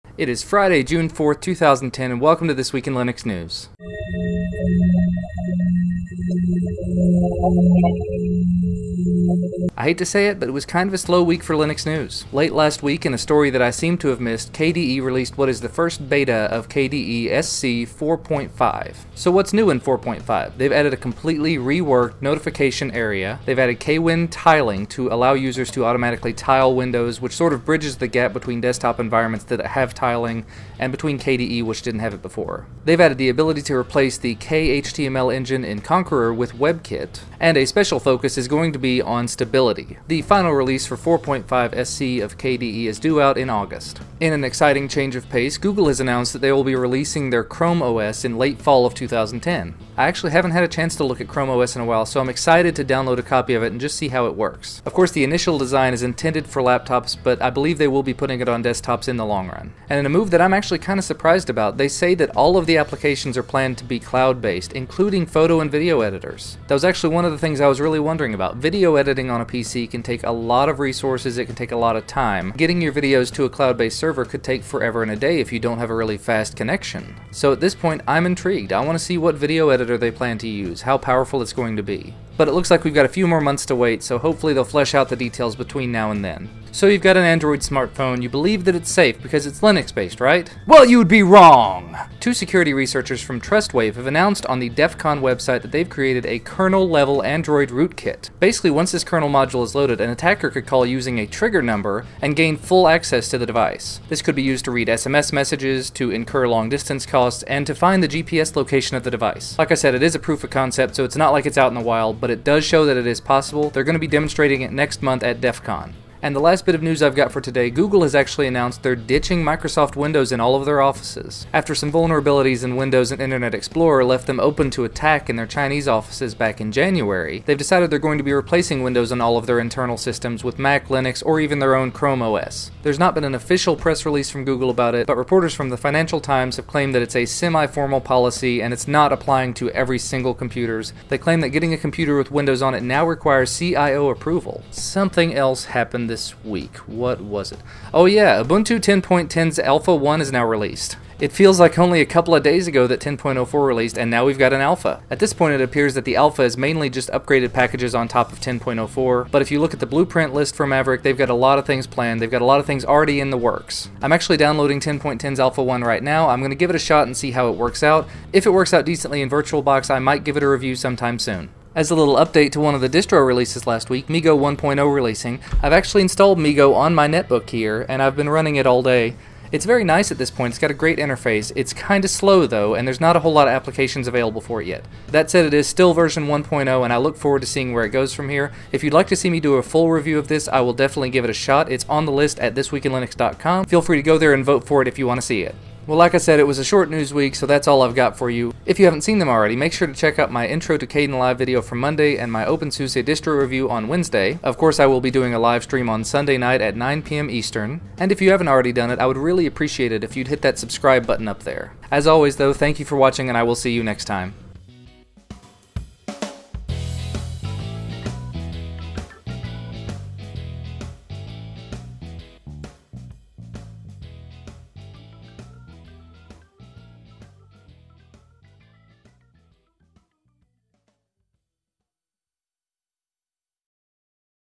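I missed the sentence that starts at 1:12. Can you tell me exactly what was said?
Getting your videos to a cloud-based server could take forever and a day if you don't have a really fast connection.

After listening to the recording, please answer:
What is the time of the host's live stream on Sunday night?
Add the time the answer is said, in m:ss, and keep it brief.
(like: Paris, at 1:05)
9 p.m. Eastern, at 3:26.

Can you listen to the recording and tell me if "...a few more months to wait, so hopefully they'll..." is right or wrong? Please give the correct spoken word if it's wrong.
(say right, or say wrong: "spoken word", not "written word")
right.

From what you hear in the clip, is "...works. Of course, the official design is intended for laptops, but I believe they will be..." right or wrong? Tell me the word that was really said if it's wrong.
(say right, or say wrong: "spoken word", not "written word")
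wrong: "initial", not "official".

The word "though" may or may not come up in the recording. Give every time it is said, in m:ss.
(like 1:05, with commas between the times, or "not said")
3:02, 3:32.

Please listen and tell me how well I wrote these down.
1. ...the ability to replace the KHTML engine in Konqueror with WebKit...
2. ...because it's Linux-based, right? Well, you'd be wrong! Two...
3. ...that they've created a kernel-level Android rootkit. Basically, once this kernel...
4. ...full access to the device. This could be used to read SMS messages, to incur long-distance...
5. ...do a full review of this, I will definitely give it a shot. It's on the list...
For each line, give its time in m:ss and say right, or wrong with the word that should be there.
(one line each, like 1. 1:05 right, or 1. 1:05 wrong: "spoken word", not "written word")
1. 0:33 right
2. 1:29 right
3. 1:35 right
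4. 1:42 right
5. 3:09 right.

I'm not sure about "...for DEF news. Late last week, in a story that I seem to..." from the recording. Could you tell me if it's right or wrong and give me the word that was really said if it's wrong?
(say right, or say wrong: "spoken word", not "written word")
wrong: "Linux", not "DEF".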